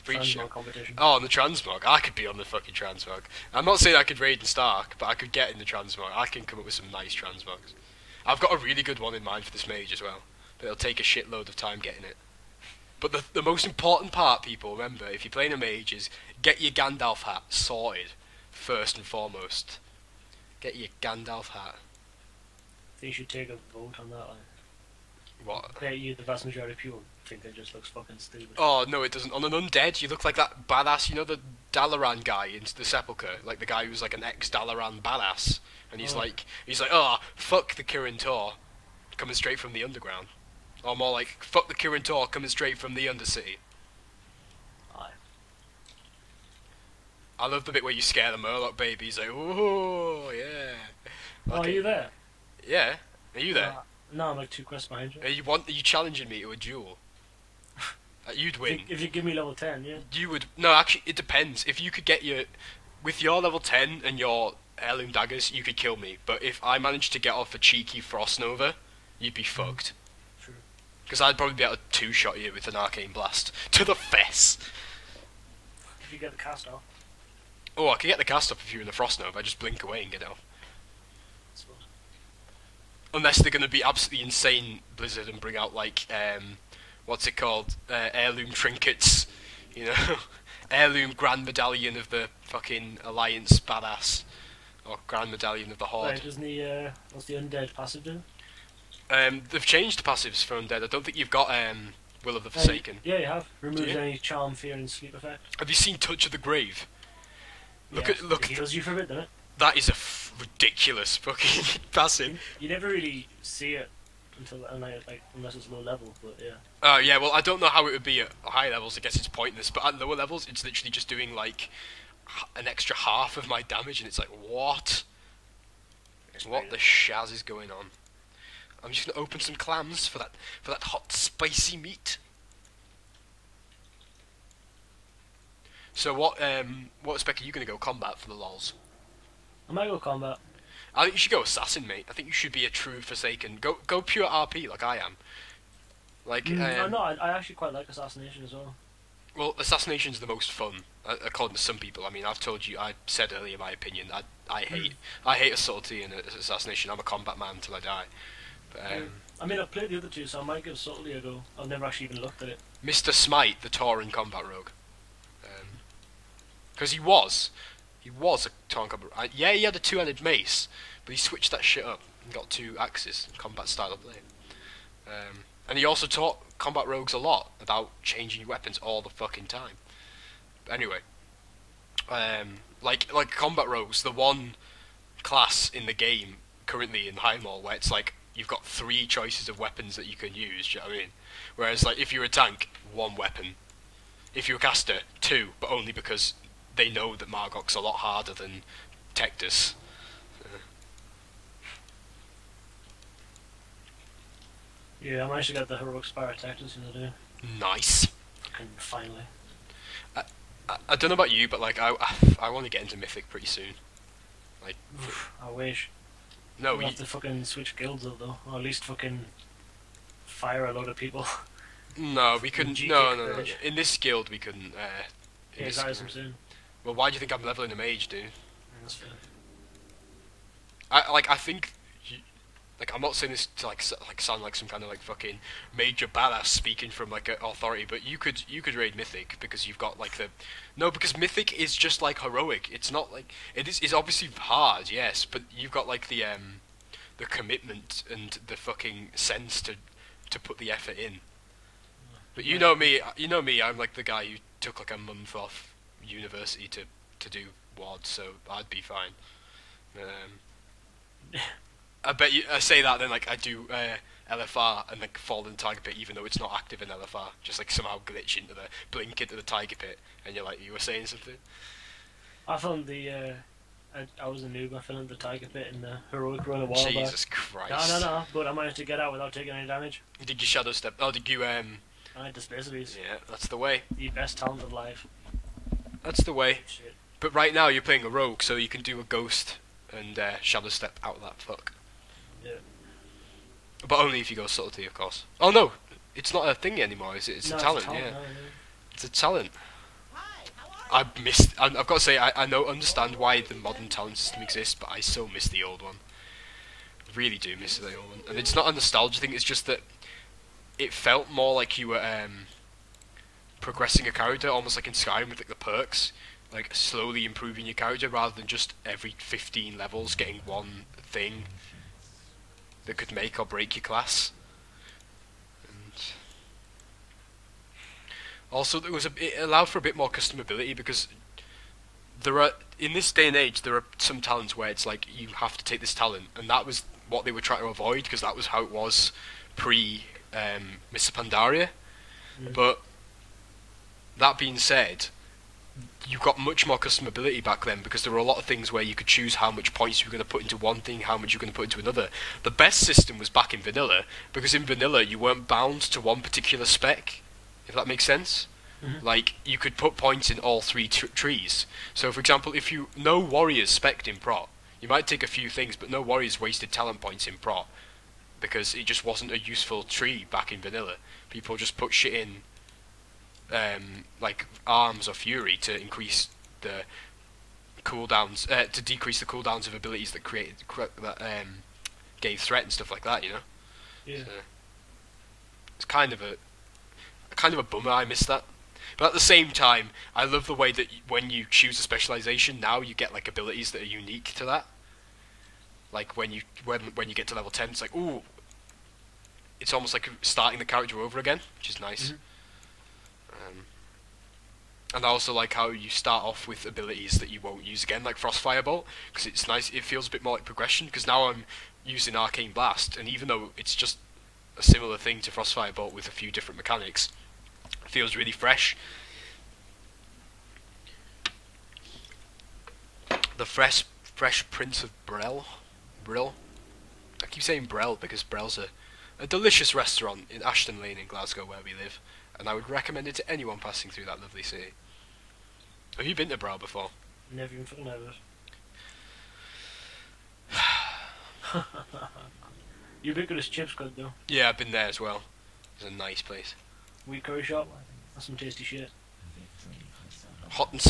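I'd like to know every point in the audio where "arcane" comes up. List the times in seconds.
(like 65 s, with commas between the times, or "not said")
72 s, 412 s.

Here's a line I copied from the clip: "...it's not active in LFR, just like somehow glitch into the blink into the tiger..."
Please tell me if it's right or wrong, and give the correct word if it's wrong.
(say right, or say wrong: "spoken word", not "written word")
right.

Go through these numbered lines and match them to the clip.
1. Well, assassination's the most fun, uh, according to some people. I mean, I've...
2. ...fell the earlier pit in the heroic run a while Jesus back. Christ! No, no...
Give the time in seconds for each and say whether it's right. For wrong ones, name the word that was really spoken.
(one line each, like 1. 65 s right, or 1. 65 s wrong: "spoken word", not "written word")
1. 149 s right
2. 274 s wrong: "tiger", not "earlier".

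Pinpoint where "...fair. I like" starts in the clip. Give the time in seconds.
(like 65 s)
228 s.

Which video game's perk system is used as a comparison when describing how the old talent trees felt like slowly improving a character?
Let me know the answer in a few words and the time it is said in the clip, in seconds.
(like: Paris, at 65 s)
Skyrim, at 314 s.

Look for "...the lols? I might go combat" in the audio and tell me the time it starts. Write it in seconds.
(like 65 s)
138 s.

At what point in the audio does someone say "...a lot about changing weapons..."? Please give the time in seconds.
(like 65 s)
177 s.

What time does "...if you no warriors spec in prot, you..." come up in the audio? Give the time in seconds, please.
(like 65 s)
362 s.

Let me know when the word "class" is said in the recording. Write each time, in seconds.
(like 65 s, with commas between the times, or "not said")
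185 s, 323 s.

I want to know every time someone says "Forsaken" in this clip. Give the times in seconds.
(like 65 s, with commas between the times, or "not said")
102 s, 143 s.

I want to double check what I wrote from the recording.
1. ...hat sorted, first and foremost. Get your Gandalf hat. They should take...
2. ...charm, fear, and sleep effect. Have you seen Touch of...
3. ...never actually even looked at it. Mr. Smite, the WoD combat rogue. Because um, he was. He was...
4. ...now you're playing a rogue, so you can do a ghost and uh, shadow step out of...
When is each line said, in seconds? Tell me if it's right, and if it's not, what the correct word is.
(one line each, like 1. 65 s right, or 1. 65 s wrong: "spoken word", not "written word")
1. 17 s right
2. 104 s right
3. 161 s wrong: "Tauren", not "WoD"
4. 287 s right.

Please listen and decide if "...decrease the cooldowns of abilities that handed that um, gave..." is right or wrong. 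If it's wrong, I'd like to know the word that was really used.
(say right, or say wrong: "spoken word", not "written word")
wrong: "created", not "handed".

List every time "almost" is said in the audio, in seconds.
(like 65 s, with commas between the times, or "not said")
314 s, 399 s.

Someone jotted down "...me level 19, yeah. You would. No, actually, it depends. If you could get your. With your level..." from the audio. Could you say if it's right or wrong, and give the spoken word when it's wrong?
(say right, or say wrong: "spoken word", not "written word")
wrong: "10", not "19".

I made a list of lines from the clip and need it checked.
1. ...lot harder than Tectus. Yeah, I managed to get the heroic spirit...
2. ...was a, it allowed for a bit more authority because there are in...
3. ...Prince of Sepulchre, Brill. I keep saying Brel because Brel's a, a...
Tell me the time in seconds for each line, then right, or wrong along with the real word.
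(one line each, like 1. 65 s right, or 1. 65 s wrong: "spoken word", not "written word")
1. 197 s right
2. 328 s wrong: "customability", not "authority"
3. 424 s wrong: "Brel", not "Sepulchre".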